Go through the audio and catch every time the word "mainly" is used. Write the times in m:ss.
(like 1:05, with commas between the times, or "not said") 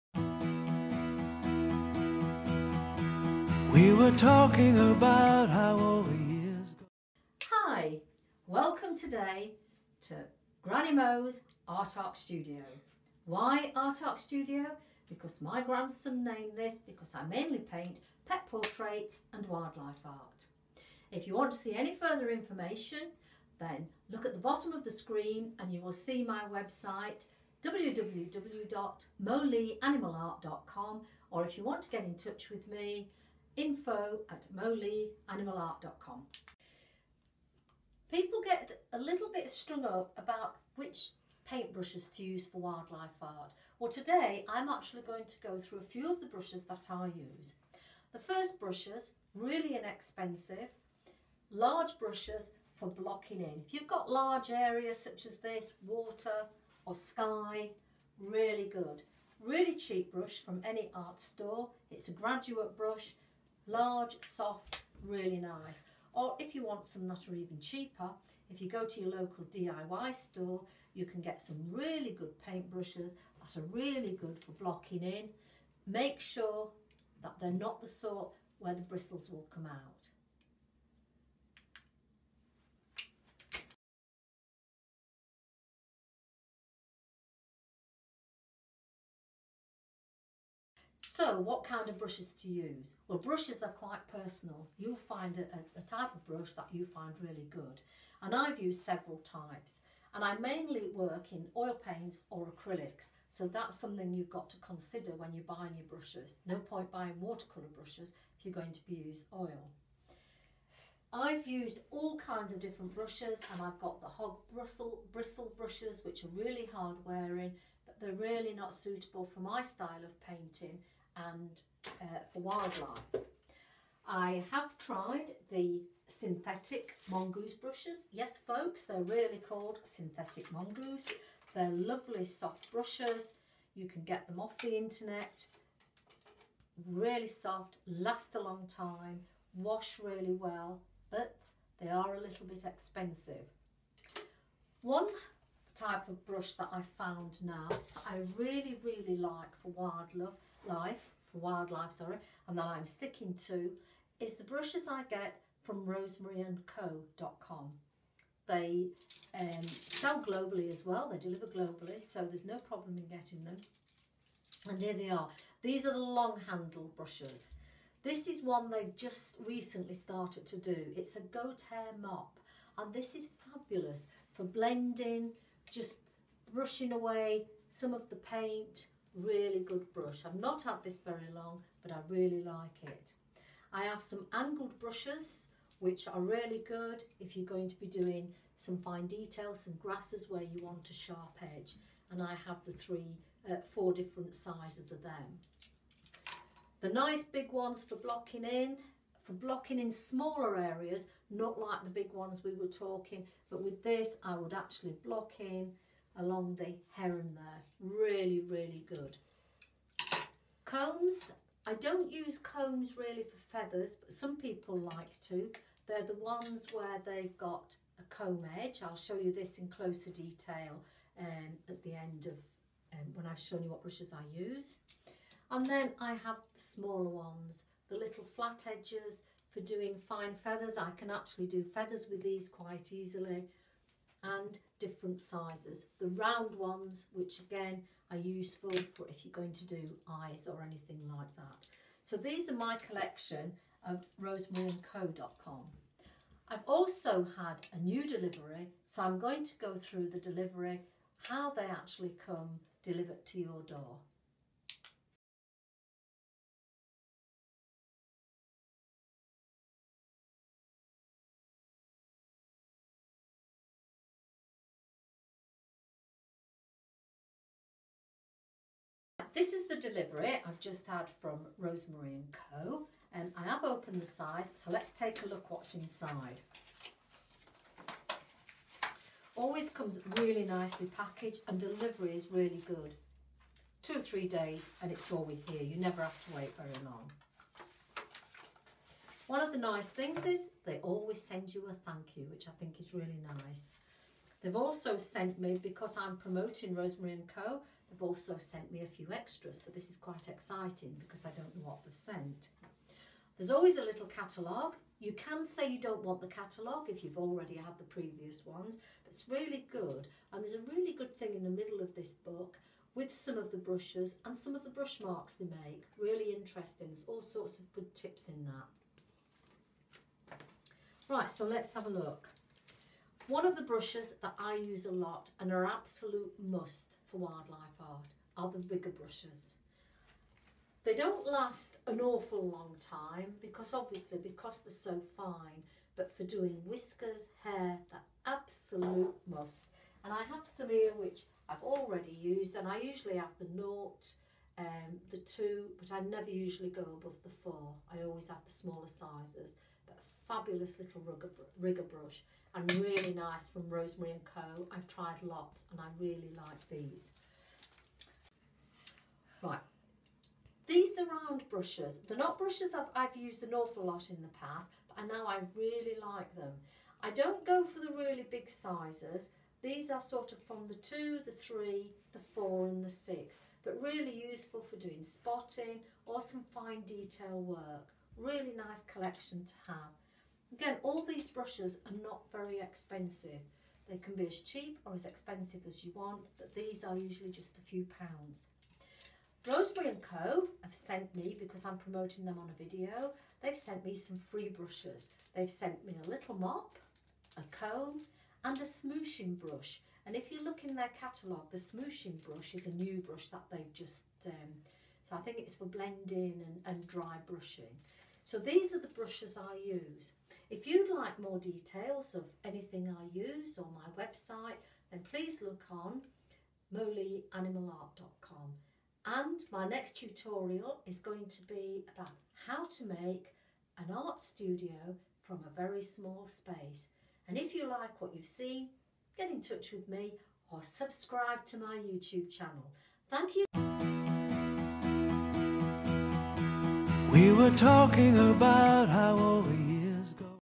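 0:17, 1:40.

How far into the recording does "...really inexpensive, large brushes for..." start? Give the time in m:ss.
0:49.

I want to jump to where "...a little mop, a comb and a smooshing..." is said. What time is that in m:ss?
6:36.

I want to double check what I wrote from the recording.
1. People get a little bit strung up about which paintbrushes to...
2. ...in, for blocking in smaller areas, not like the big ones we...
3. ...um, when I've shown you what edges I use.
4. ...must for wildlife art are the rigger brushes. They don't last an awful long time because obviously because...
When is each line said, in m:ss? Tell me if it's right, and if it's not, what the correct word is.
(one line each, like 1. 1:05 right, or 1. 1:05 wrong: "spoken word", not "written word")
1. 0:38 right
2. 3:18 right
3. 3:42 wrong: "brushes", not "edges"
4. 5:26 right.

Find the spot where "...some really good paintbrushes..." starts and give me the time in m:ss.
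1:11.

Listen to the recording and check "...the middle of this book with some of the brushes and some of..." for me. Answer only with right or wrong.
right.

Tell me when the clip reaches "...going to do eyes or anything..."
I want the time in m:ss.
3:59.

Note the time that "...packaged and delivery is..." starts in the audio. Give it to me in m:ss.
4:40.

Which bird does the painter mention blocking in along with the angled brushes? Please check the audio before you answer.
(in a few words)
Heron.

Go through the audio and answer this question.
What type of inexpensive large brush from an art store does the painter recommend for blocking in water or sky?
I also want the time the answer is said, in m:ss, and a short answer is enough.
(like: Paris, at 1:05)
Graduate brush, at 1:02.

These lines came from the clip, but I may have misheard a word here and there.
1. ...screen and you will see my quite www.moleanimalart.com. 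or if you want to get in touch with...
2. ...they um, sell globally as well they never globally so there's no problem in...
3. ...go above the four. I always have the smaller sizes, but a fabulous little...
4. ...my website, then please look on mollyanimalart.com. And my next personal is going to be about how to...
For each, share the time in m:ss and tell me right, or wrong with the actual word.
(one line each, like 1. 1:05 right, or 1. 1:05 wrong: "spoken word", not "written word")
1. 0:24 wrong: "website", not "quite"
2. 2:38 wrong: "deliver", not "never"
3. 5:46 right
4. 6:53 wrong: "tutorial", not "personal".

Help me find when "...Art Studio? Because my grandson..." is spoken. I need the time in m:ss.
0:14.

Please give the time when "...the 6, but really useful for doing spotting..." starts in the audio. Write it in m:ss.
6:12.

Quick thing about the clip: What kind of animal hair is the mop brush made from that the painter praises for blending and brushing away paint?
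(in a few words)
Goat hair.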